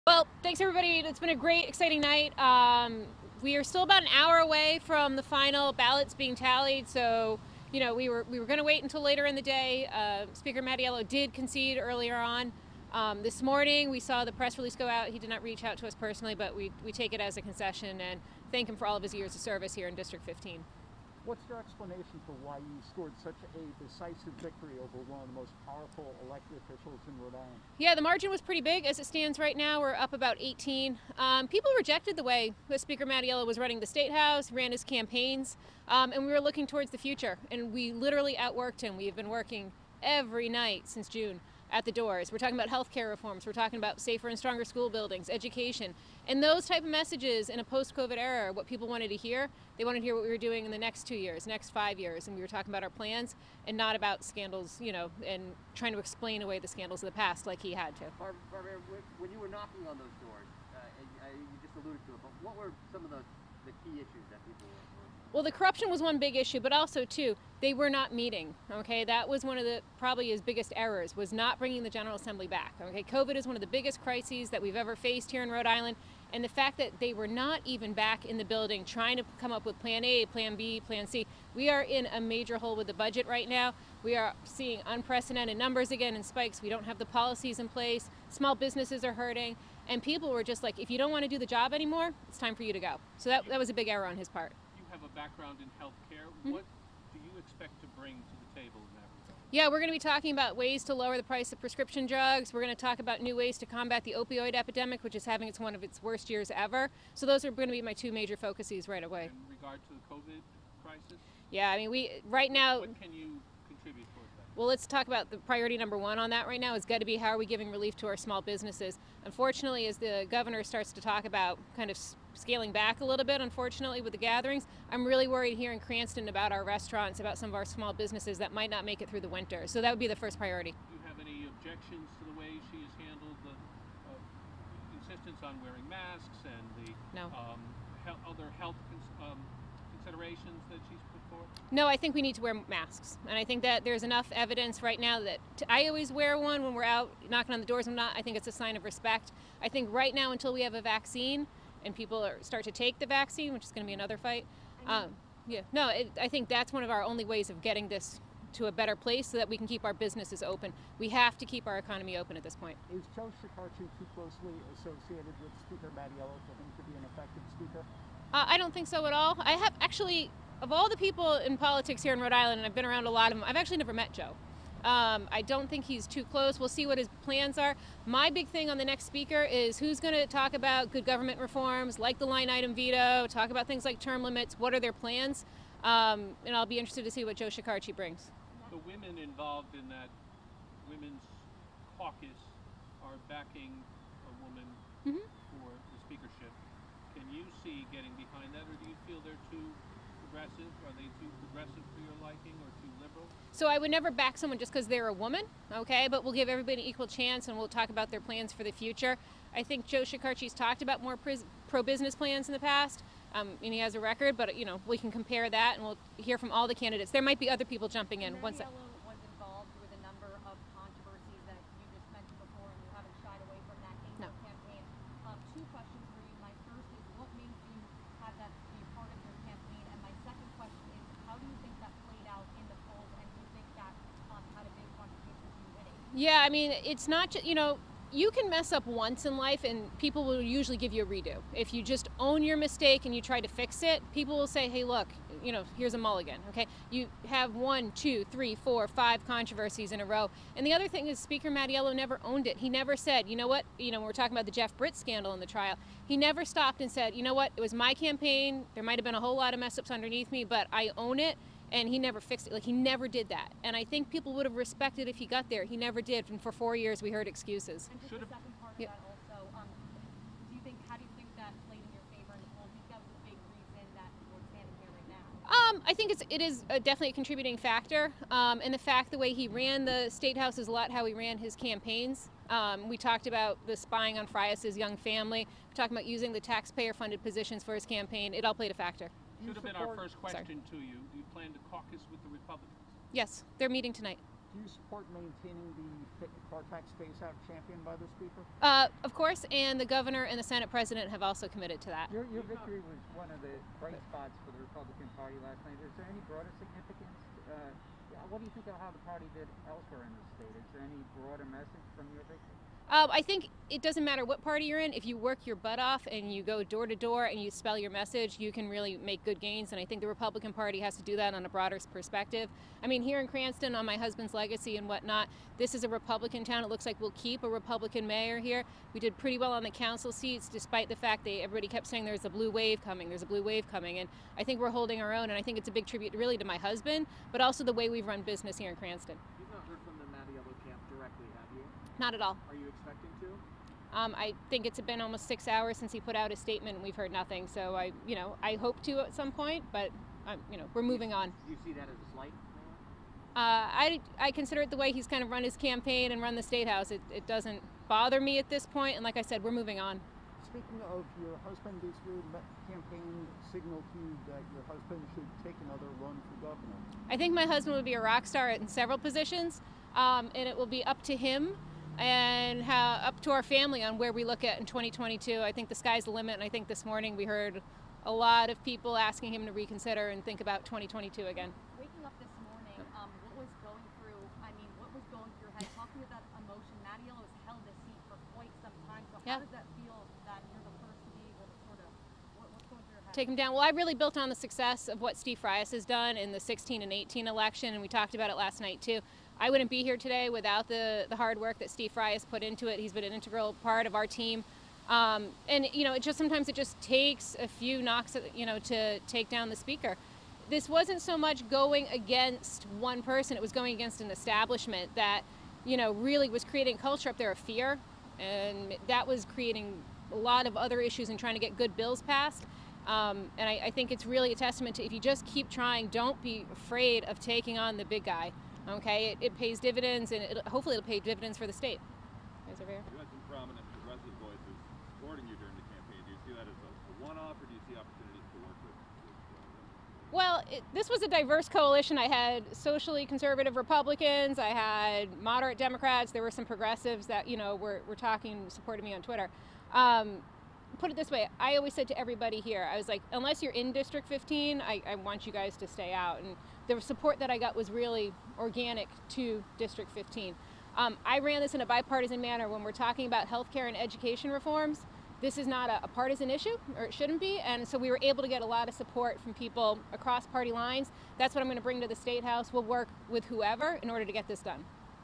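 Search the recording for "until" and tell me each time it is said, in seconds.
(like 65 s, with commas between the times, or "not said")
8 s, 150 s.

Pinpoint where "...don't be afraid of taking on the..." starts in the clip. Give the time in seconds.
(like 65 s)
425 s.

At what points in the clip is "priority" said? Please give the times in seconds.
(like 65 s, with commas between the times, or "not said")
115 s, 130 s.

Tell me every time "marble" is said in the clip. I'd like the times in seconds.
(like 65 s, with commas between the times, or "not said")
not said.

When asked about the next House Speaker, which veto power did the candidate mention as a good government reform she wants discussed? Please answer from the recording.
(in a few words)
line item veto.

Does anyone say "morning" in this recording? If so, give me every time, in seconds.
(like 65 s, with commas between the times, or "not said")
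13 s, 376 s, 382 s.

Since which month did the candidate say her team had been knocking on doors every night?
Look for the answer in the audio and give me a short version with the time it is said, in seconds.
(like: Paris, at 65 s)
June, at 41 s.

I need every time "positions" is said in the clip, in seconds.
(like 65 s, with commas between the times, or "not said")
287 s, 368 s.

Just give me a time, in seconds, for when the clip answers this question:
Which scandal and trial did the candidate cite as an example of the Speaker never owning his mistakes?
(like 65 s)
254 s.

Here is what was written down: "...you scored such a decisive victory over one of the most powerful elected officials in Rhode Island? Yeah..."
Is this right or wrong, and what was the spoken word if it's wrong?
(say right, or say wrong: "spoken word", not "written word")
right.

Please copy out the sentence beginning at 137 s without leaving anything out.
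um, he other health um, considerations that she's put No, I think we need to wear masks.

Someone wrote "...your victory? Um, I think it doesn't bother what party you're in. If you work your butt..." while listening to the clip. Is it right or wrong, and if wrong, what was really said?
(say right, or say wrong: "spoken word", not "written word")
wrong: "matter", not "bother".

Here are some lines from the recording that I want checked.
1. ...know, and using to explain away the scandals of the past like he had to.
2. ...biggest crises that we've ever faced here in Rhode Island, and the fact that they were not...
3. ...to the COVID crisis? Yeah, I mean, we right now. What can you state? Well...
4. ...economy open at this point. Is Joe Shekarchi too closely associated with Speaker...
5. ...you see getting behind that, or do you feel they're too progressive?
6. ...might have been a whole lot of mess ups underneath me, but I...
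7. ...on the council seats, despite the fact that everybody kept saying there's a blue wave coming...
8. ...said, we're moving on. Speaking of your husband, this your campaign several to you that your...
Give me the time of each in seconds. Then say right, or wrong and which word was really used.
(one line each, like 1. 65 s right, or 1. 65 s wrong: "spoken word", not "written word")
1. 54 s wrong: "trying", not "using"
2. 73 s right
3. 109 s wrong: "contribute", not "state"
4. 161 s right
5. 197 s right
6. 258 s right
7. 329 s right
8. 359 s wrong: "signal", not "several".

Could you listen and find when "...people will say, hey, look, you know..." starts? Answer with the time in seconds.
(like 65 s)
244 s.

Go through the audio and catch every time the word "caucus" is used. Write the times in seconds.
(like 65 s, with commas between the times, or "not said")
191 s, 291 s.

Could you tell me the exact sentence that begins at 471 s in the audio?
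That's what I'm going to bring to the State House.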